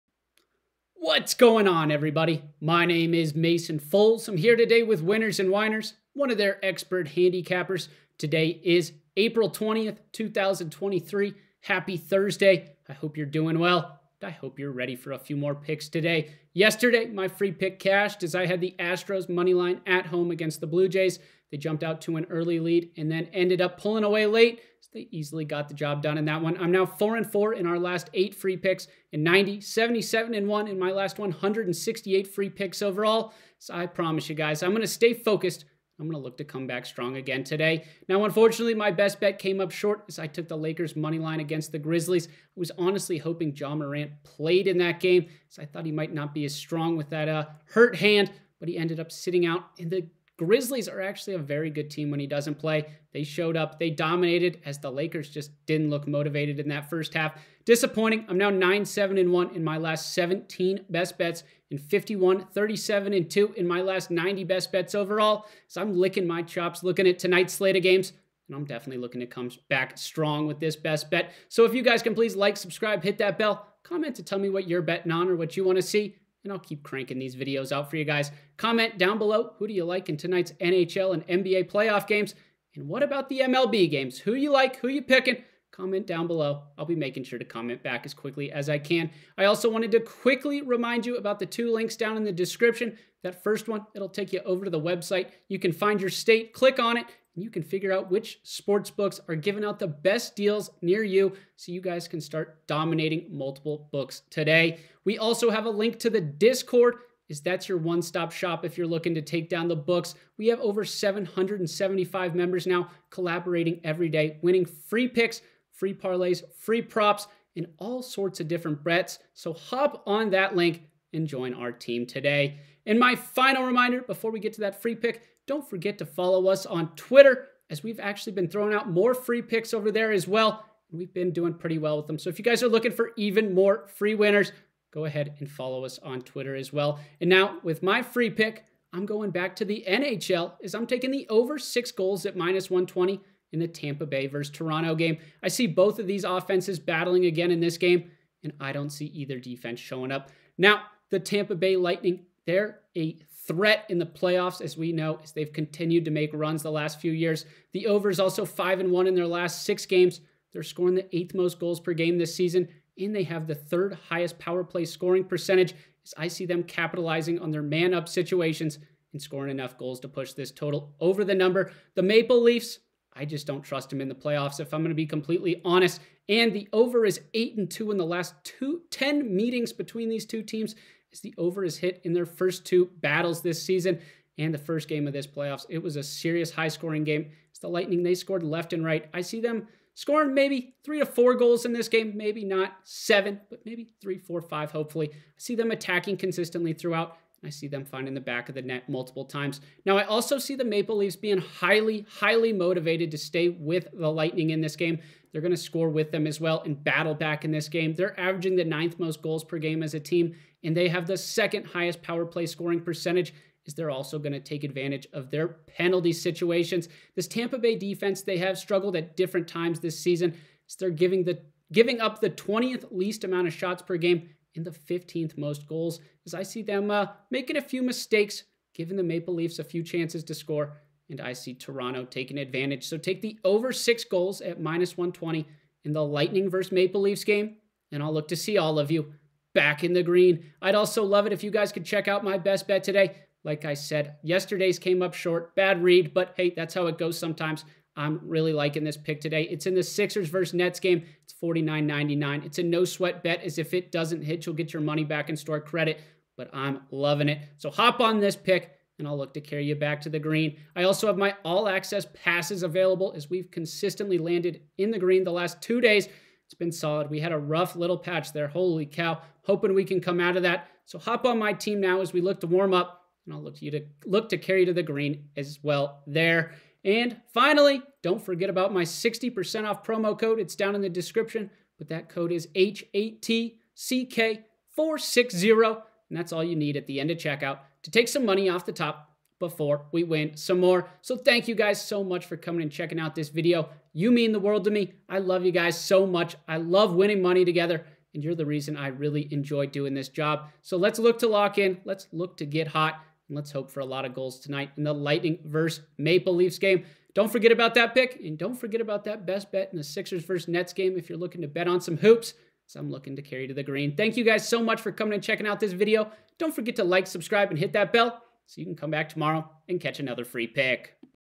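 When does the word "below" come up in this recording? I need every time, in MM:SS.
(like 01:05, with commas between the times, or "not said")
01:19, 01:26.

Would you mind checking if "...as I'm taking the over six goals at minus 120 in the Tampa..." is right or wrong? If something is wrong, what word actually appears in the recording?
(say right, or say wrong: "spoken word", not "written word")
right.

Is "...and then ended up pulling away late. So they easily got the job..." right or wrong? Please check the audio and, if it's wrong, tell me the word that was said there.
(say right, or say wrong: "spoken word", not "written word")
right.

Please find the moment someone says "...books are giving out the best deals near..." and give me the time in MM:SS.
01:38.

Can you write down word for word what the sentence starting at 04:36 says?
And finally, don't forget about my 60% off promo code.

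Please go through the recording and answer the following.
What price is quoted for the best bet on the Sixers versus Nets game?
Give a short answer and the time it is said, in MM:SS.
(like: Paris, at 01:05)
49.99, at 04:11.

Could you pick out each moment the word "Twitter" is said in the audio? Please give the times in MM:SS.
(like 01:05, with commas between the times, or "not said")
02:06, 02:16.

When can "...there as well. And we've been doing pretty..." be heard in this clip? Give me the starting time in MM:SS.
02:09.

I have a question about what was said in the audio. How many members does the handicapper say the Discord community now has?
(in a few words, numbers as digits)
775.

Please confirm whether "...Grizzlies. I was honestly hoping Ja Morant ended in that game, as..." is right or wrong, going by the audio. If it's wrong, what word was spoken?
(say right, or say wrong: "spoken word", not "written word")
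wrong: "played", not "ended".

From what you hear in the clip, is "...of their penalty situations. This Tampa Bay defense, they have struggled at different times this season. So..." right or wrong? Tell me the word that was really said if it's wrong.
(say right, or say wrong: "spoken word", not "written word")
right.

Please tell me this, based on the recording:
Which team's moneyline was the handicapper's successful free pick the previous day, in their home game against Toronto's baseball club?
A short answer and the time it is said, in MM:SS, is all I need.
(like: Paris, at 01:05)
Astros, at 00:18.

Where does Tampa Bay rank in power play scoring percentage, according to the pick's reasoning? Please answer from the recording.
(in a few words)
Third.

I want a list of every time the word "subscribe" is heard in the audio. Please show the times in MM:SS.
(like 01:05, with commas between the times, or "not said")
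01:12, 05:17.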